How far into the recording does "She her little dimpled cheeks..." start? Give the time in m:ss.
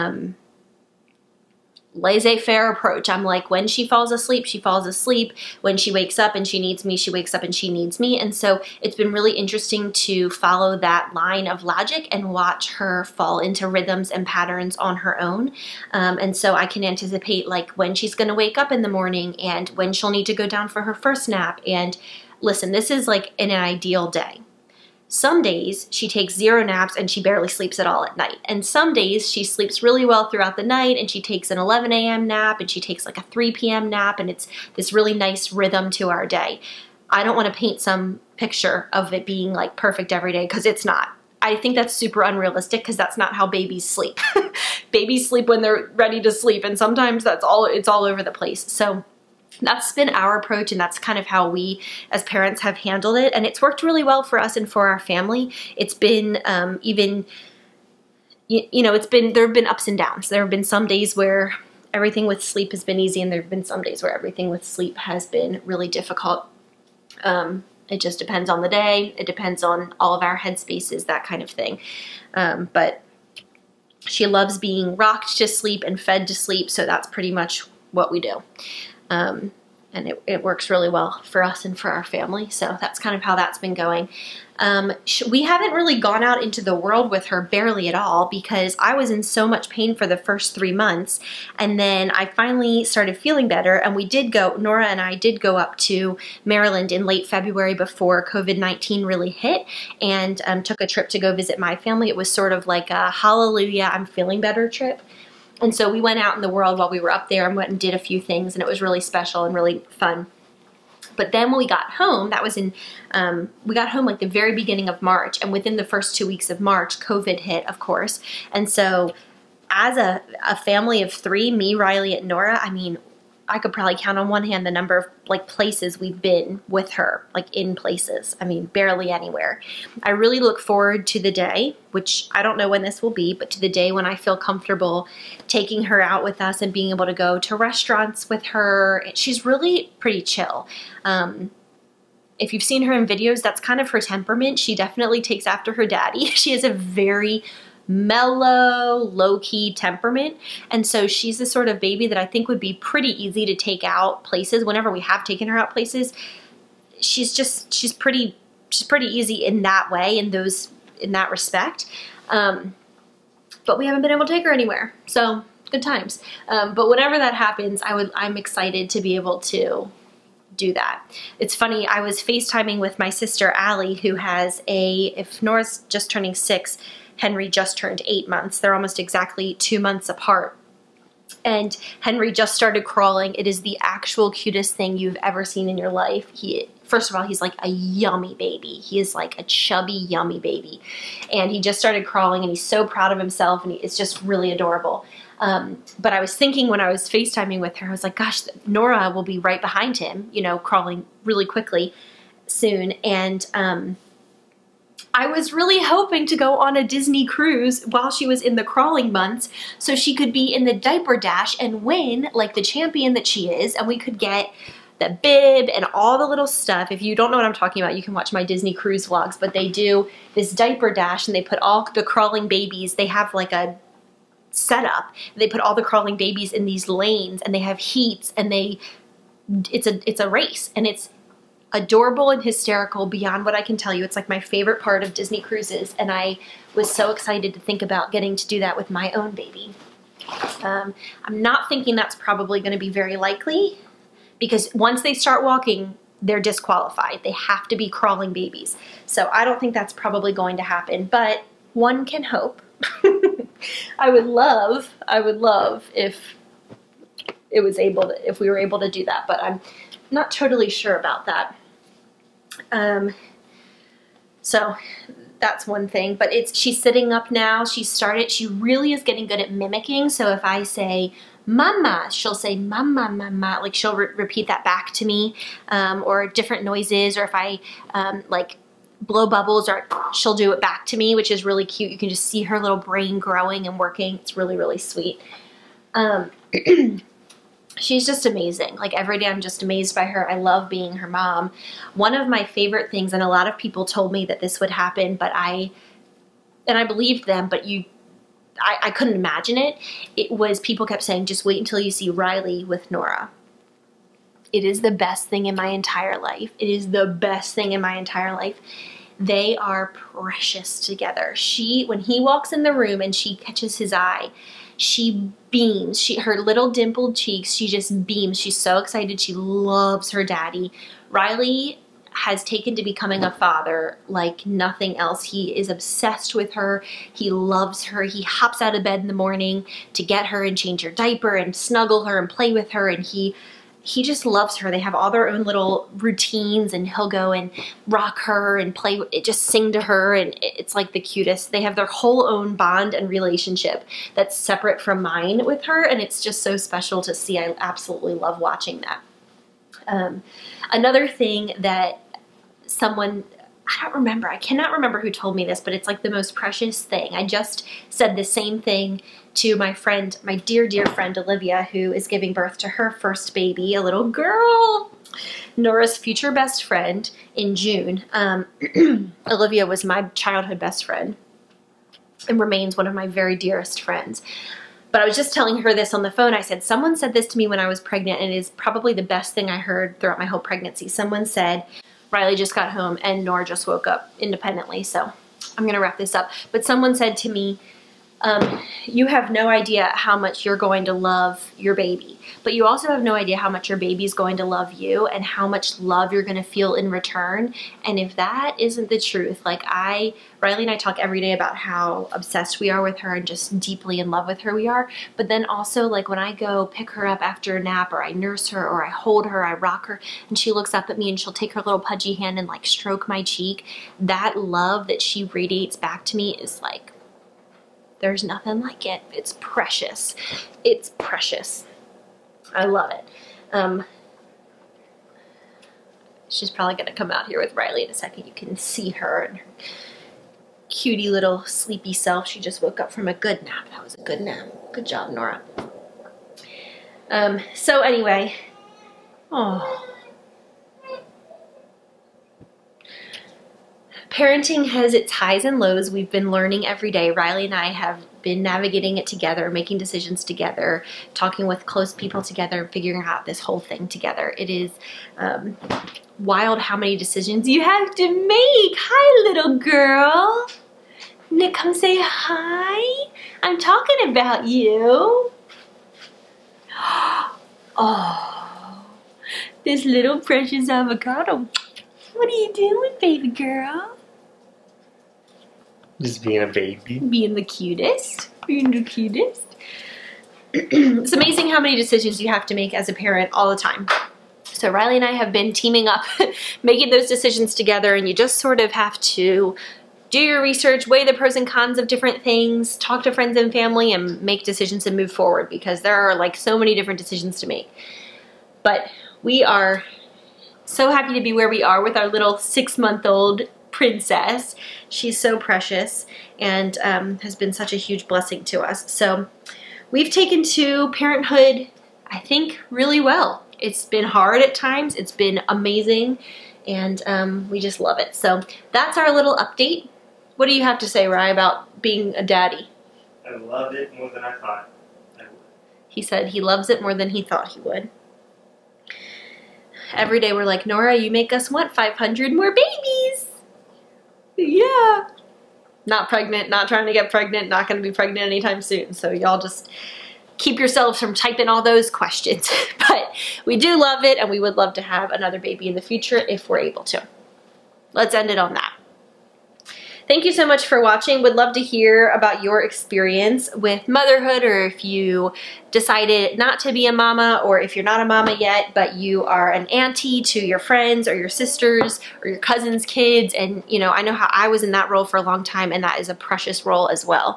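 5:15.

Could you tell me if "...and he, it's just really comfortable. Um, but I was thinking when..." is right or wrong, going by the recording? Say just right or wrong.
wrong.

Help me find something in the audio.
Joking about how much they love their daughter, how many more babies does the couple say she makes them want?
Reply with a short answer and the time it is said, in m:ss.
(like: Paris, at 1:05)
500, at 8:51.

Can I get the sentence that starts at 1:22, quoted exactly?
So that's kind of how that's been going.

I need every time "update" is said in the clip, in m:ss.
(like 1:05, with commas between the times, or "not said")
8:39.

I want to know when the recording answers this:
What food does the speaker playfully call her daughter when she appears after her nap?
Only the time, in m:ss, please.
7:50.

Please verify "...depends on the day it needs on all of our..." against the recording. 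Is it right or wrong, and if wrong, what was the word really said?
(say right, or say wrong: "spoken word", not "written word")
wrong: "depends", not "needs".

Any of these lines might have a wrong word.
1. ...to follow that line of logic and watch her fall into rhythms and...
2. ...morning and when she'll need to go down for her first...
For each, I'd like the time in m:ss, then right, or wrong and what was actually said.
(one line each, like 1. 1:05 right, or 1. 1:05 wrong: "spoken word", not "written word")
1. 0:09 right
2. 0:18 right.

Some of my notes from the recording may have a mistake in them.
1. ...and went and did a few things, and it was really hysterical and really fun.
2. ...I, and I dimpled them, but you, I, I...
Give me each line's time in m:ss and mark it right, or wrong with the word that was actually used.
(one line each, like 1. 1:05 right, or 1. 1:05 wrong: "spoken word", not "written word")
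1. 1:47 wrong: "special", not "hysterical"
2. 4:55 wrong: "believed", not "dimpled".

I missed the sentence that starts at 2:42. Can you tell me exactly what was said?
Um, but we haven't been able to take her anywhere.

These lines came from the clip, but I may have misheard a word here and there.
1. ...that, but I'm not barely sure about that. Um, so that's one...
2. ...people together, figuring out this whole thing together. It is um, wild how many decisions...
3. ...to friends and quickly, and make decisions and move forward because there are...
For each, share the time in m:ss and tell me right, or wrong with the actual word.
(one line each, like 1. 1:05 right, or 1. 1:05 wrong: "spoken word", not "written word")
1. 4:19 wrong: "totally", not "barely"
2. 7:31 right
3. 8:13 wrong: "family", not "quickly".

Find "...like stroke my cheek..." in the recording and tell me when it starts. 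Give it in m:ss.
6:52.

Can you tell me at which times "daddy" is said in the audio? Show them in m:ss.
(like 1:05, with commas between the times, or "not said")
2:25, 5:20, 8:42.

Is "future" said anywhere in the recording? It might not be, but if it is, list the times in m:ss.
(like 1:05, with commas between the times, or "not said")
6:05, 9:05.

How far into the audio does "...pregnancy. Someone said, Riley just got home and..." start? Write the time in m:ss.
6:20.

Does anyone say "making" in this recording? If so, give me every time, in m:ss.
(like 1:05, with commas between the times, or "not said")
7:29, 8:06.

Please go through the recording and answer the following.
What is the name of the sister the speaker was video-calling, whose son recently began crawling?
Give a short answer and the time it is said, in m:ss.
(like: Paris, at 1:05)
Allie, at 2:53.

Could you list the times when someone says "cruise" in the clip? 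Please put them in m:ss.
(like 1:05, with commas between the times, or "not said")
3:27, 3:38, 3:55.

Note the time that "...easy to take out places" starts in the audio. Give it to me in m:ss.
2:33.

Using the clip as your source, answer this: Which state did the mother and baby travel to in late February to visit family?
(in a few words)
Maryland.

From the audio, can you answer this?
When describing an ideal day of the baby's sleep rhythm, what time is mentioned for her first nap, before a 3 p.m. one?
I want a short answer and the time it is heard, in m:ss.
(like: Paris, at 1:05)
11 a.m., at 0:31.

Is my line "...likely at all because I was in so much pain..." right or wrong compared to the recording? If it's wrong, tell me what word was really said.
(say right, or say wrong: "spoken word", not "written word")
wrong: "barely", not "likely".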